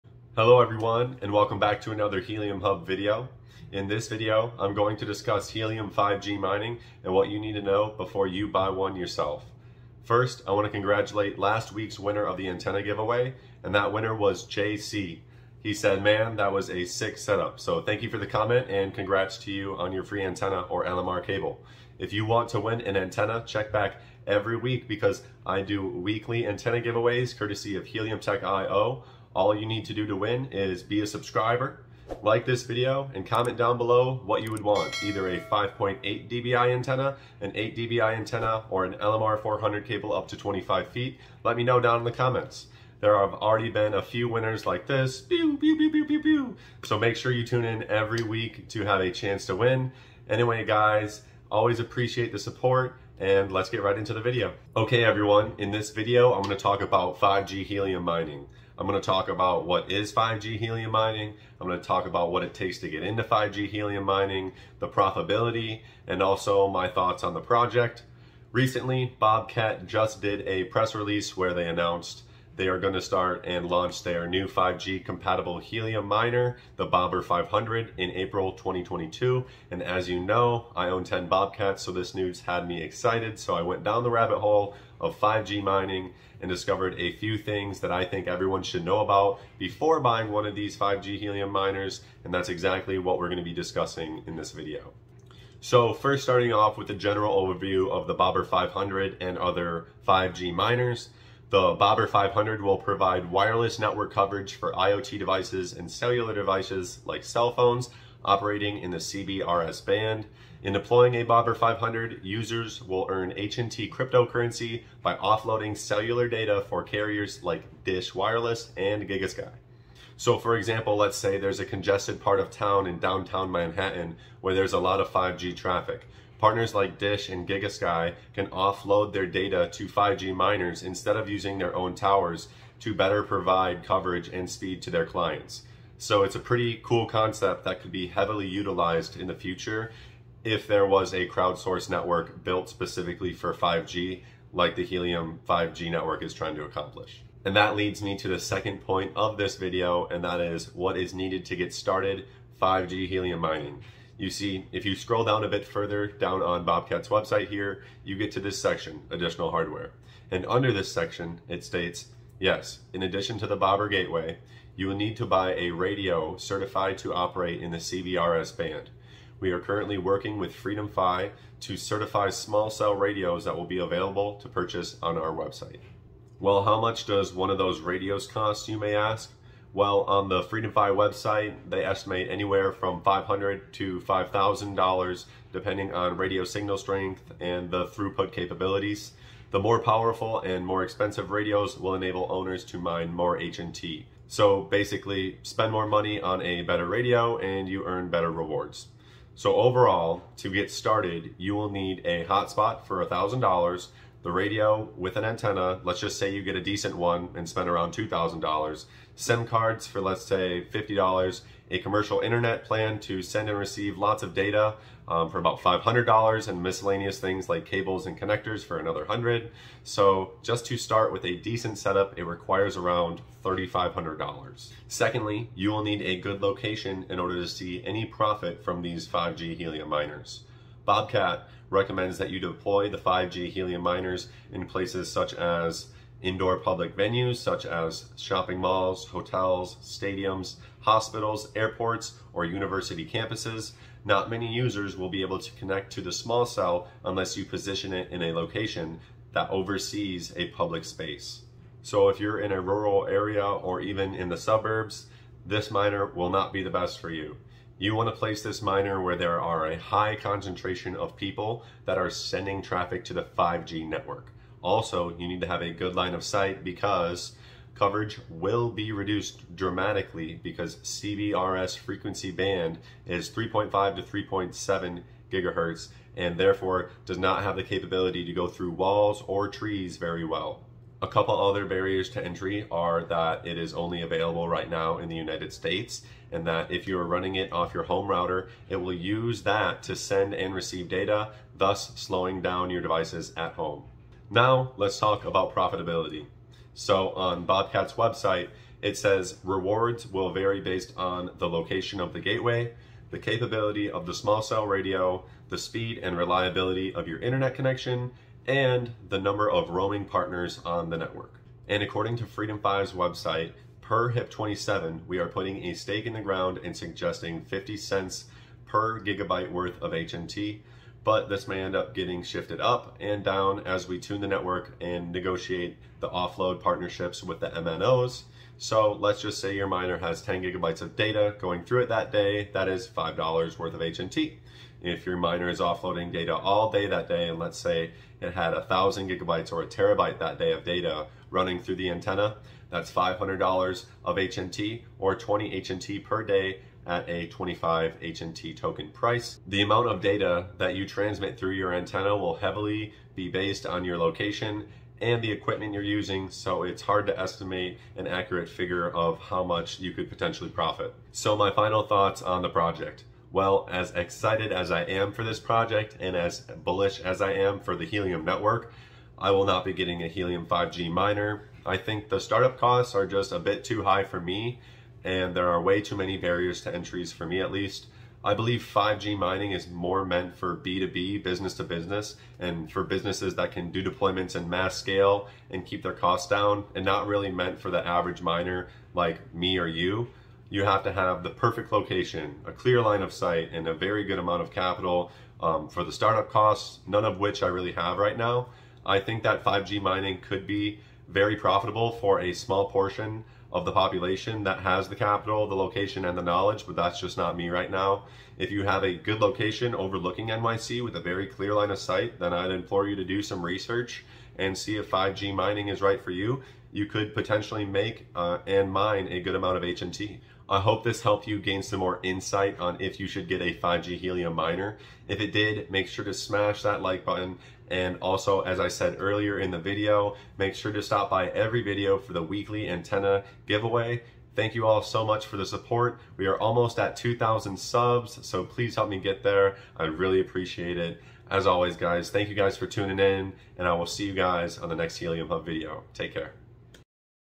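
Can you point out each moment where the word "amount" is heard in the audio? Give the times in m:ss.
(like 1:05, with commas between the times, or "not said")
5:49, 6:34, 6:59.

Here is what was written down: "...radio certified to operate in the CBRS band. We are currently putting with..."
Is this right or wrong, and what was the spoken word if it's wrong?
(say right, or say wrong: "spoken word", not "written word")
wrong: "working", not "putting".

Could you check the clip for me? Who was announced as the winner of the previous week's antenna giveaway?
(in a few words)
JC.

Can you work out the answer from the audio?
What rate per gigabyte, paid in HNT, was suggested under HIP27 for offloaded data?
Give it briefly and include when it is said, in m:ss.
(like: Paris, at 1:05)
50 cents, at 5:17.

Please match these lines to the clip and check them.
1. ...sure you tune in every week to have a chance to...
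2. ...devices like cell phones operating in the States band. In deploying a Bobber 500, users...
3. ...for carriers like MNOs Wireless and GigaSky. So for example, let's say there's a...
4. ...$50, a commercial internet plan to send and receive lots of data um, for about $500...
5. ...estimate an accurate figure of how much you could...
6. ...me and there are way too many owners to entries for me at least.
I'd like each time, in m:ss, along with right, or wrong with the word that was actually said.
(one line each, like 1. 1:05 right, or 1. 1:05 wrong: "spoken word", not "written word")
1. 0:47 right
2. 1:46 wrong: "CBRS", not "States"
3. 1:56 wrong: "Dish", not "MNOs"
4. 3:30 right
5. 5:57 right
6. 6:14 wrong: "barriers", not "owners".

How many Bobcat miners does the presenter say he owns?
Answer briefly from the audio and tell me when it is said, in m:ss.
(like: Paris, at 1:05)
10, at 1:21.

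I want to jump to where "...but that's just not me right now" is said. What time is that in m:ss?
6:46.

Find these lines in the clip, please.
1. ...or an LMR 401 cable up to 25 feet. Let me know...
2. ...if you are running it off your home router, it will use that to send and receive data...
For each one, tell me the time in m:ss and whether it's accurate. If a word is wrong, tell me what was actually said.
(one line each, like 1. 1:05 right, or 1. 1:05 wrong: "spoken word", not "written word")
1. 0:38 wrong: "400", not "401"
2. 4:46 right.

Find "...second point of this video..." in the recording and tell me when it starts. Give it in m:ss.
2:28.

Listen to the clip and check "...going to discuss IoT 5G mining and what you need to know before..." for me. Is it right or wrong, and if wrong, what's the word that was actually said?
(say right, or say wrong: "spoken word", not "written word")
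wrong: "Helium", not "IoT".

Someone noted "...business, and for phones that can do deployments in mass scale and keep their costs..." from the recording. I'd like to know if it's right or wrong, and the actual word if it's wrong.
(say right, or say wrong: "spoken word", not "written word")
wrong: "businesses", not "phones".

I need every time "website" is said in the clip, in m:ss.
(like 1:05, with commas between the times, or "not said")
2:37, 2:55, 3:00, 4:57, 5:12.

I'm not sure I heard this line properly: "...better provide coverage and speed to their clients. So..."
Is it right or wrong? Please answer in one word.
right.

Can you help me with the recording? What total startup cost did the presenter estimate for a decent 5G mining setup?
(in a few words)
$3,500.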